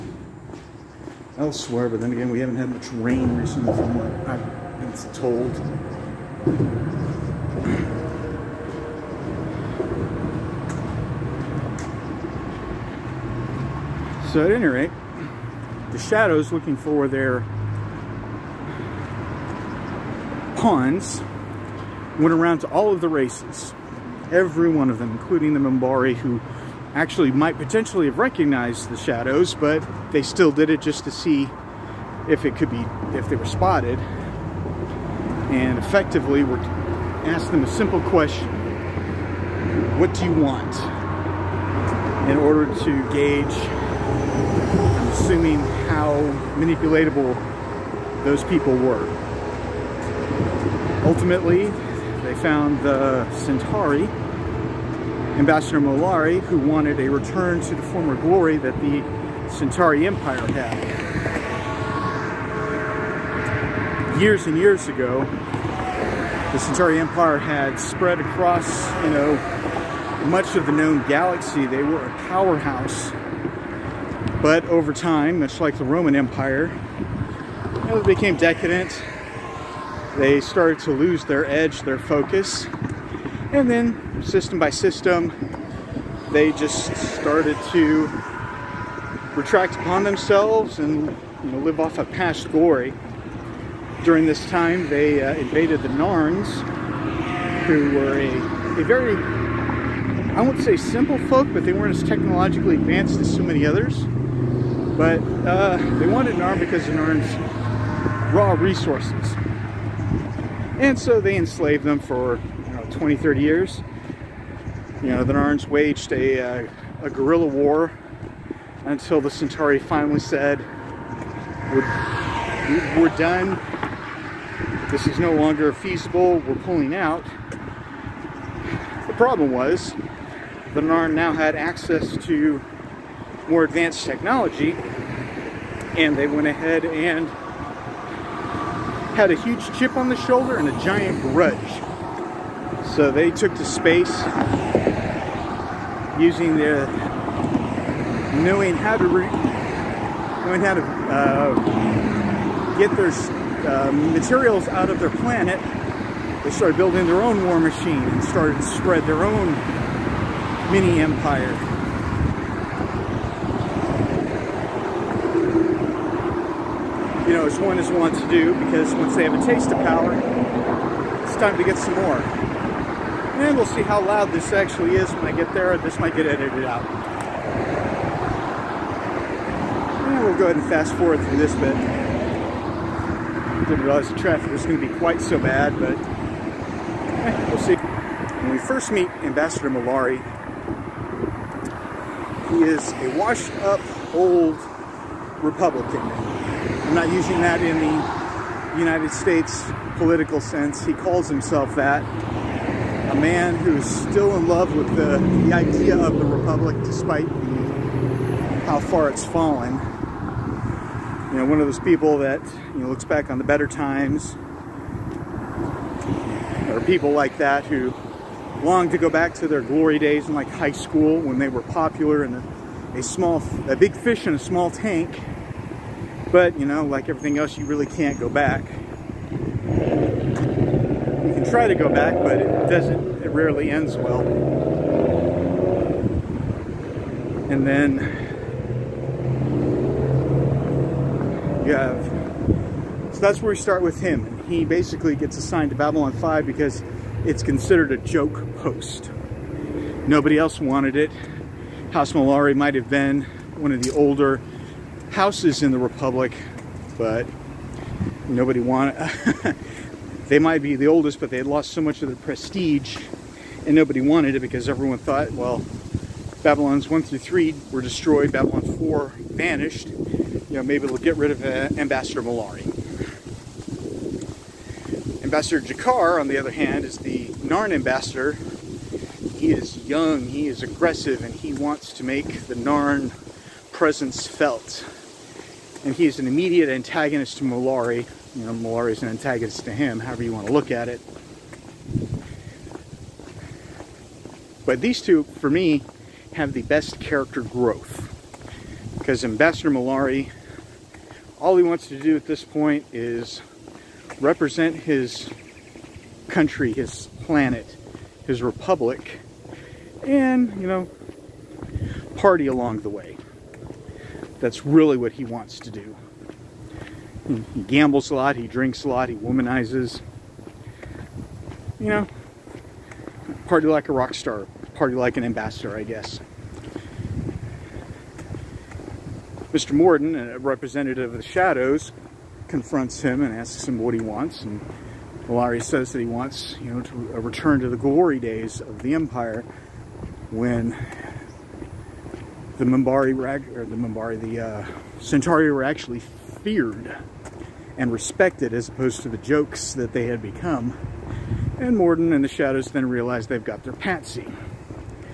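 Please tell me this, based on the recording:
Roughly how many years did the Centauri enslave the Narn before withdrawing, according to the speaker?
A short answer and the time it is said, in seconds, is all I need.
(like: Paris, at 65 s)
20, 30 years, at 112 s.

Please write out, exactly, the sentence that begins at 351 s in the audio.
And Morden and the Shadows then realize they've got their patsy.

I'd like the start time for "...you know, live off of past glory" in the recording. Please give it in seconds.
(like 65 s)
91 s.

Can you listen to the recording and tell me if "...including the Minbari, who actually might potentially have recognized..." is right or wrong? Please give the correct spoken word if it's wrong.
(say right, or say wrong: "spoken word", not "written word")
right.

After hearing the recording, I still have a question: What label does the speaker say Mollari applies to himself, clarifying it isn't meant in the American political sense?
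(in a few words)
Republican.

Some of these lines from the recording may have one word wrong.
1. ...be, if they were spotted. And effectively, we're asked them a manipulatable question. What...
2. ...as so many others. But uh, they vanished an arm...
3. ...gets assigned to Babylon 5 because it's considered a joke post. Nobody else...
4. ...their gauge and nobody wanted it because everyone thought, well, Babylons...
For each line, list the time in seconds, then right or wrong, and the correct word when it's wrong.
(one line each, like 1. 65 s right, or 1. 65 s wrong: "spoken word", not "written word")
1. 32 s wrong: "simple", not "manipulatable"
2. 103 s wrong: "wanted", not "vanished"
3. 245 s right
4. 262 s wrong: "prestige", not "gauge".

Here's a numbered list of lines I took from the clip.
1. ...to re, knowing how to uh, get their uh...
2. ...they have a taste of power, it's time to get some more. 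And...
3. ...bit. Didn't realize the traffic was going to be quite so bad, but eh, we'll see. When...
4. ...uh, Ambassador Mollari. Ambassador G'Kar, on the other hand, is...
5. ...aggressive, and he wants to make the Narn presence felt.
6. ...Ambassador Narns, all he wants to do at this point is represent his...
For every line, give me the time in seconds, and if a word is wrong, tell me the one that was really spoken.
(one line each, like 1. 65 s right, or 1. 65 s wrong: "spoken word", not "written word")
1. 148 s right
2. 169 s right
3. 181 s right
4. 271 s right
5. 280 s right
6. 299 s wrong: "Mollari", not "Narns".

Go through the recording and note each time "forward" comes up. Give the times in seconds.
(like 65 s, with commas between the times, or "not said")
180 s.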